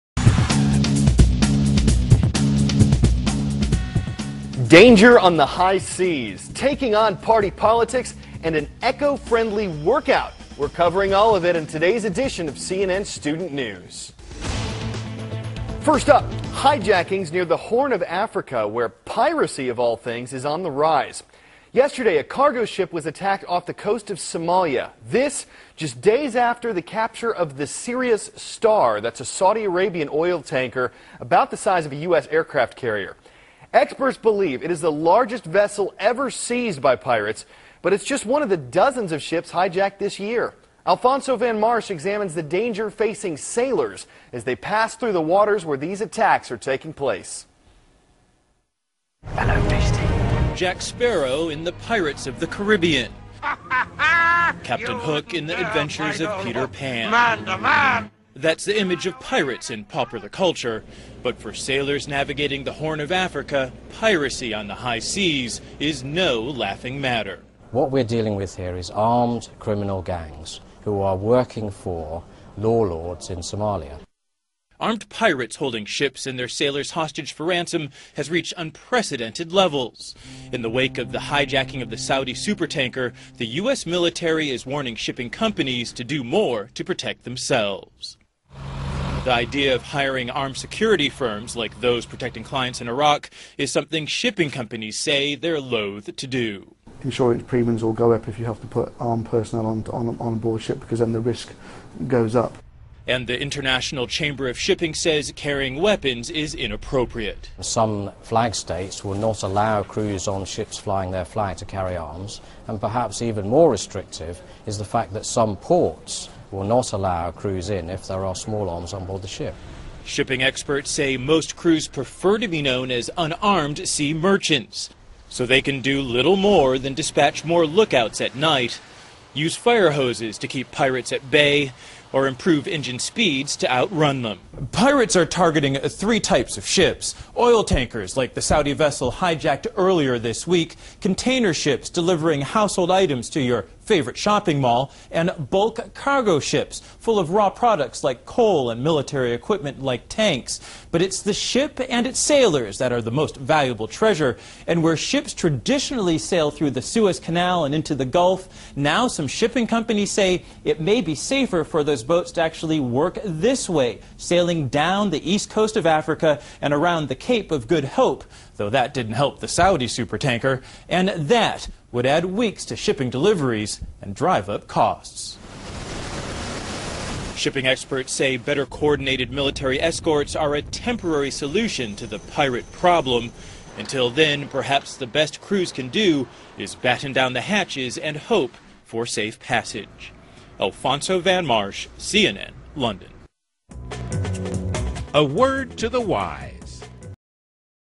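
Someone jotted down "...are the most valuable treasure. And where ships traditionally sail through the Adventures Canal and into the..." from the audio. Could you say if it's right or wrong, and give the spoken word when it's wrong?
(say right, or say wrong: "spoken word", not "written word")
wrong: "Suez", not "Adventures".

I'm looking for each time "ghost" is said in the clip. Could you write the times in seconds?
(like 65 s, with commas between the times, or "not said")
not said.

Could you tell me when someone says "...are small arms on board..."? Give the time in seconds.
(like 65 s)
118 s.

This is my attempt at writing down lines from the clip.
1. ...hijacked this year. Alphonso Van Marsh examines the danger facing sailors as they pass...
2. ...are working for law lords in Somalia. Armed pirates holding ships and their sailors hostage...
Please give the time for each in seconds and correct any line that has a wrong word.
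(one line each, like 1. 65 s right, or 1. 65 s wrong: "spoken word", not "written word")
1. 39 s right
2. 71 s right.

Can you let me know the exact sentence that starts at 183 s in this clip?
Until then, perhaps the best crews can do is batten down the hatches and hope for safe passage.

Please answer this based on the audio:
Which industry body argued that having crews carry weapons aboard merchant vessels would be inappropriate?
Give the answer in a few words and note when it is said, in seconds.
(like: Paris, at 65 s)
International Chamber of Shipping, at 103 s.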